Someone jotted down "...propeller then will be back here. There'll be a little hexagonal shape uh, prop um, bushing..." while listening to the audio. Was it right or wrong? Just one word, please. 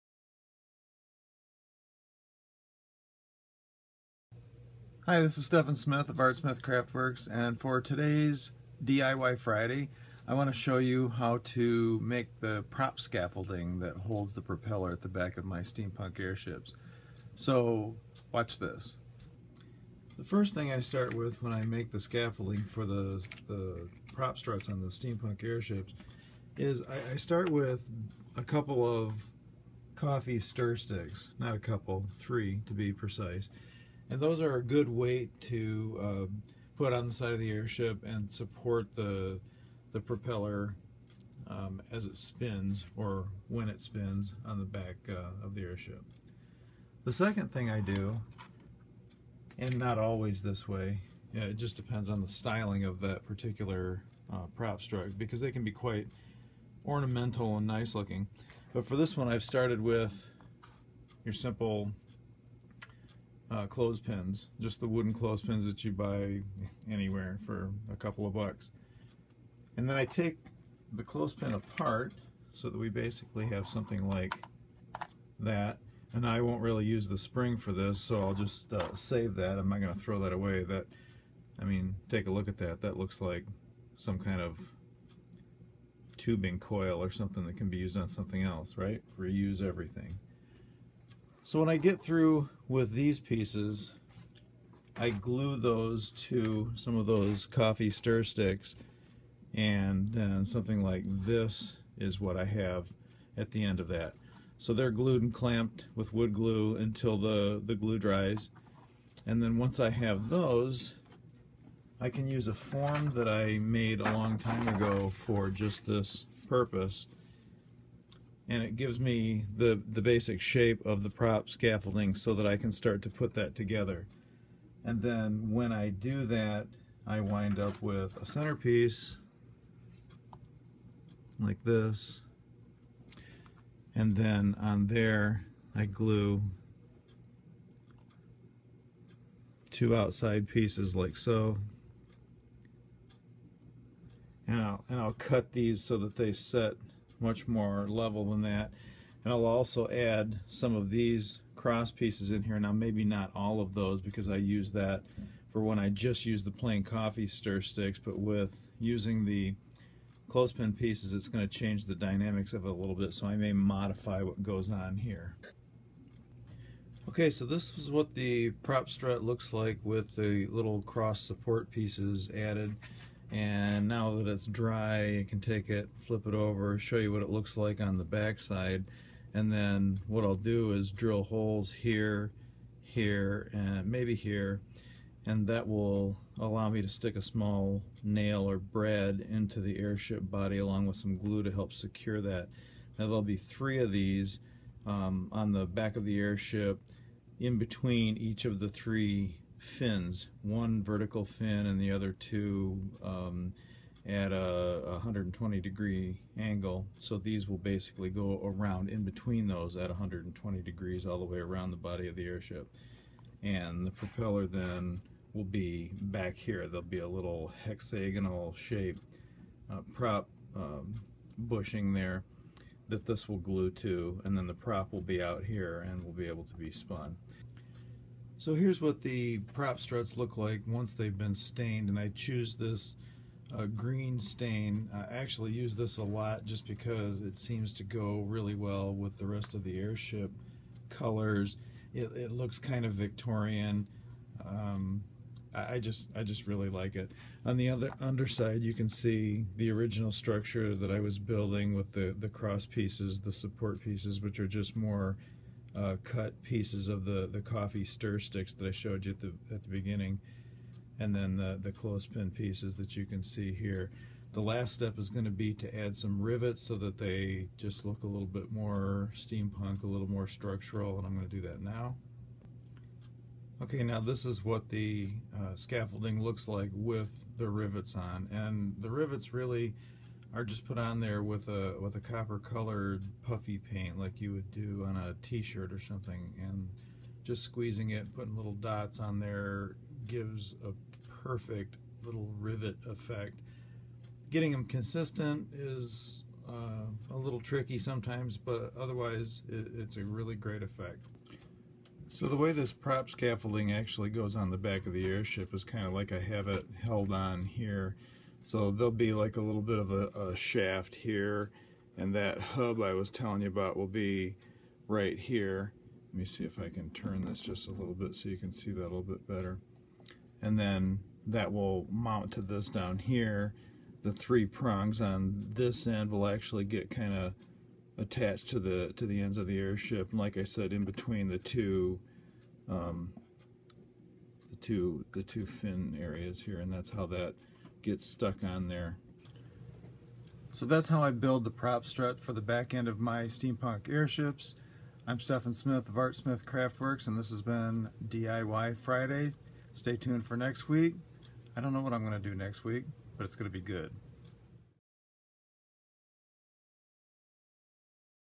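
right.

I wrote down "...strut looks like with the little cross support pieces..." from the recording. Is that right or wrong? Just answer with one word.
right.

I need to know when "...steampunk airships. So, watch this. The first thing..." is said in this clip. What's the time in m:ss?
0:15.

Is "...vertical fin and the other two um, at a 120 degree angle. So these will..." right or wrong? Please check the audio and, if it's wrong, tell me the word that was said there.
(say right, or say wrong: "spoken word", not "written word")
right.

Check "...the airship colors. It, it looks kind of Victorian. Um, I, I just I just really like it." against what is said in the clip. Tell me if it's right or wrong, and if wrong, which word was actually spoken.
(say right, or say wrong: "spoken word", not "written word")
right.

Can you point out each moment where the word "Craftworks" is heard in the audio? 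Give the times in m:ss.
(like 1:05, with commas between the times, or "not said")
0:06, 5:46.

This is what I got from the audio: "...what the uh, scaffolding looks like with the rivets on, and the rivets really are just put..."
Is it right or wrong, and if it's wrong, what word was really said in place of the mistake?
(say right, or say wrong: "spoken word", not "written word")
right.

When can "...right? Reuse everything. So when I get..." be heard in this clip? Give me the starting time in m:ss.
1:28.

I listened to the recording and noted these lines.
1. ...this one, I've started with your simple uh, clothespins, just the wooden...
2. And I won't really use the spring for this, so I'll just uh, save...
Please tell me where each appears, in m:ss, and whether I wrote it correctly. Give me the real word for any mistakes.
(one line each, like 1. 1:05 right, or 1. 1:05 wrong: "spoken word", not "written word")
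1. 0:58 right
2. 1:16 right.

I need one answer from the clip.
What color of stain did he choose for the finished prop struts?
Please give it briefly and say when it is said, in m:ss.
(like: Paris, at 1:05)
Green, at 3:53.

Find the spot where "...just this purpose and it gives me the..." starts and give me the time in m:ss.
1:55.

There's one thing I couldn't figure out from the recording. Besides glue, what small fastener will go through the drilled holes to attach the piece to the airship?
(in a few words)
Brad.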